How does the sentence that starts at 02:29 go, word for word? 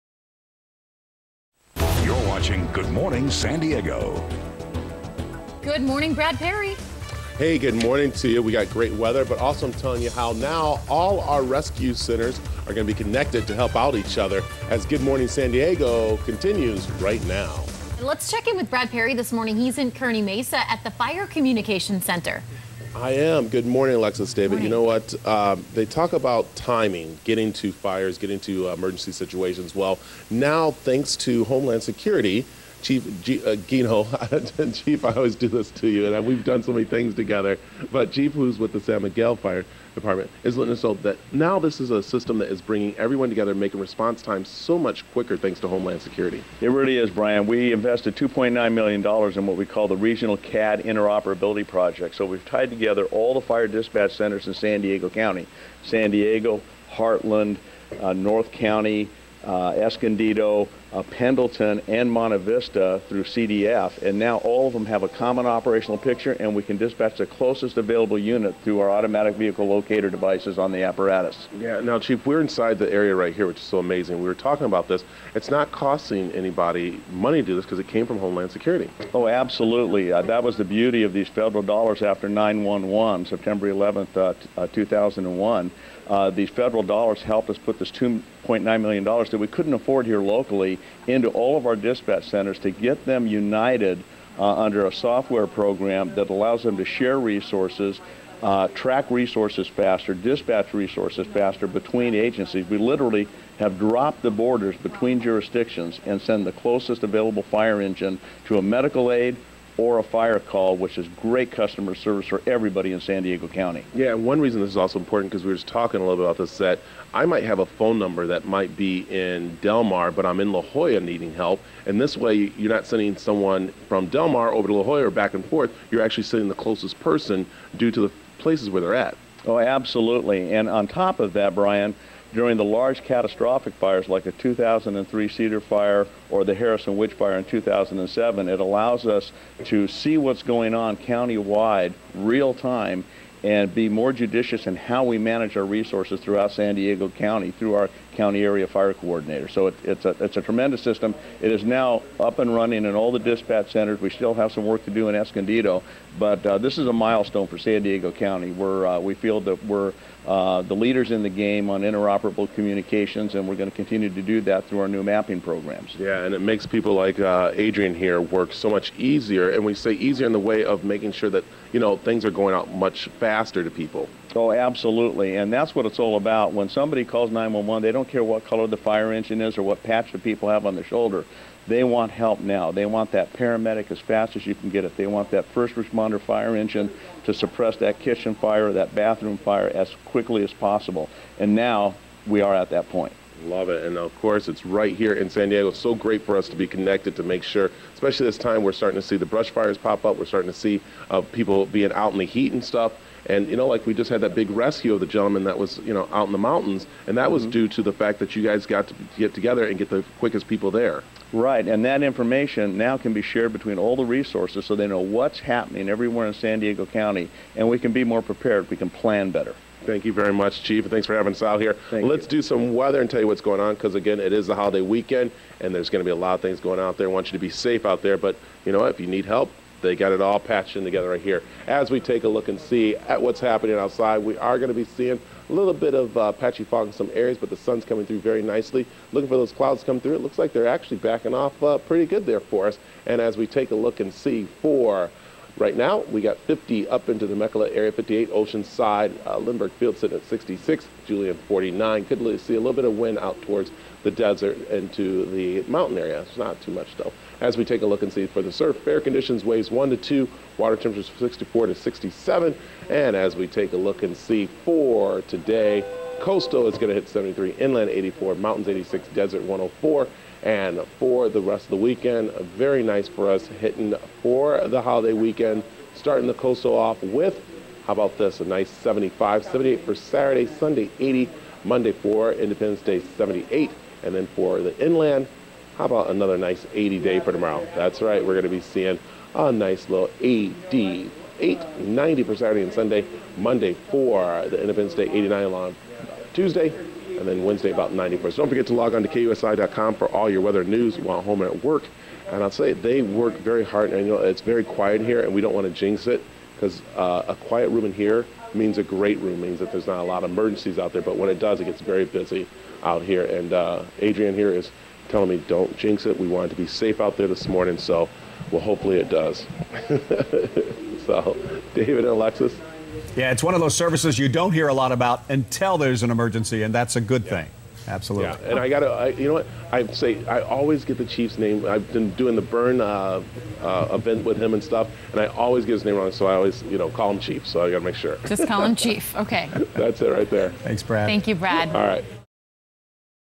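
So it, it's, a, it's a tremendous system.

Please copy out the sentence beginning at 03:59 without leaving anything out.
Looking for those clouds to come through.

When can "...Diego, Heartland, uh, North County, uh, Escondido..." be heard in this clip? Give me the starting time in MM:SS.
00:56.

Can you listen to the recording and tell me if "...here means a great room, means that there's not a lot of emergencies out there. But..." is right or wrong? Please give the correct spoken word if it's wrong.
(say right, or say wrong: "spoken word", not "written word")
right.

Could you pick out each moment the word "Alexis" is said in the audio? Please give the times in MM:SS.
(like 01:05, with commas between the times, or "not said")
00:23, 05:22.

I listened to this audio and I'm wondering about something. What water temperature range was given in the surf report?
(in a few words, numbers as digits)
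64 to 67.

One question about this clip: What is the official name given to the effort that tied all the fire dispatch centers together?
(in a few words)
Regional CAD Interoperability Project.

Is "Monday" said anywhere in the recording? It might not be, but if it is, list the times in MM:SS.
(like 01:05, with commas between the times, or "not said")
04:41, 04:53.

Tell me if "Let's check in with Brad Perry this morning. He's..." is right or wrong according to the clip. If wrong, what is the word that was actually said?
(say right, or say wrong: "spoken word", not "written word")
right.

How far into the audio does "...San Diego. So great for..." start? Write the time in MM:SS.
03:15.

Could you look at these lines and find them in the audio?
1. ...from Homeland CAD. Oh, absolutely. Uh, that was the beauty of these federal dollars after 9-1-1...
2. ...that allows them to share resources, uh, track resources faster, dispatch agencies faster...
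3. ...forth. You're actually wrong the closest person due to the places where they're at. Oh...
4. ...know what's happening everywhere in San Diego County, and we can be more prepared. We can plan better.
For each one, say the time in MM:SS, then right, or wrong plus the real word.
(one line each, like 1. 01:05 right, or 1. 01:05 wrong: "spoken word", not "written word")
1. 01:18 wrong: "Security", not "CAD"
2. 01:36 wrong: "resources", not "agencies"
3. 02:05 wrong: "sending", not "wrong"
4. 03:34 right.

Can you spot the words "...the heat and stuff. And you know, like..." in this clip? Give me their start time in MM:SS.
03:22.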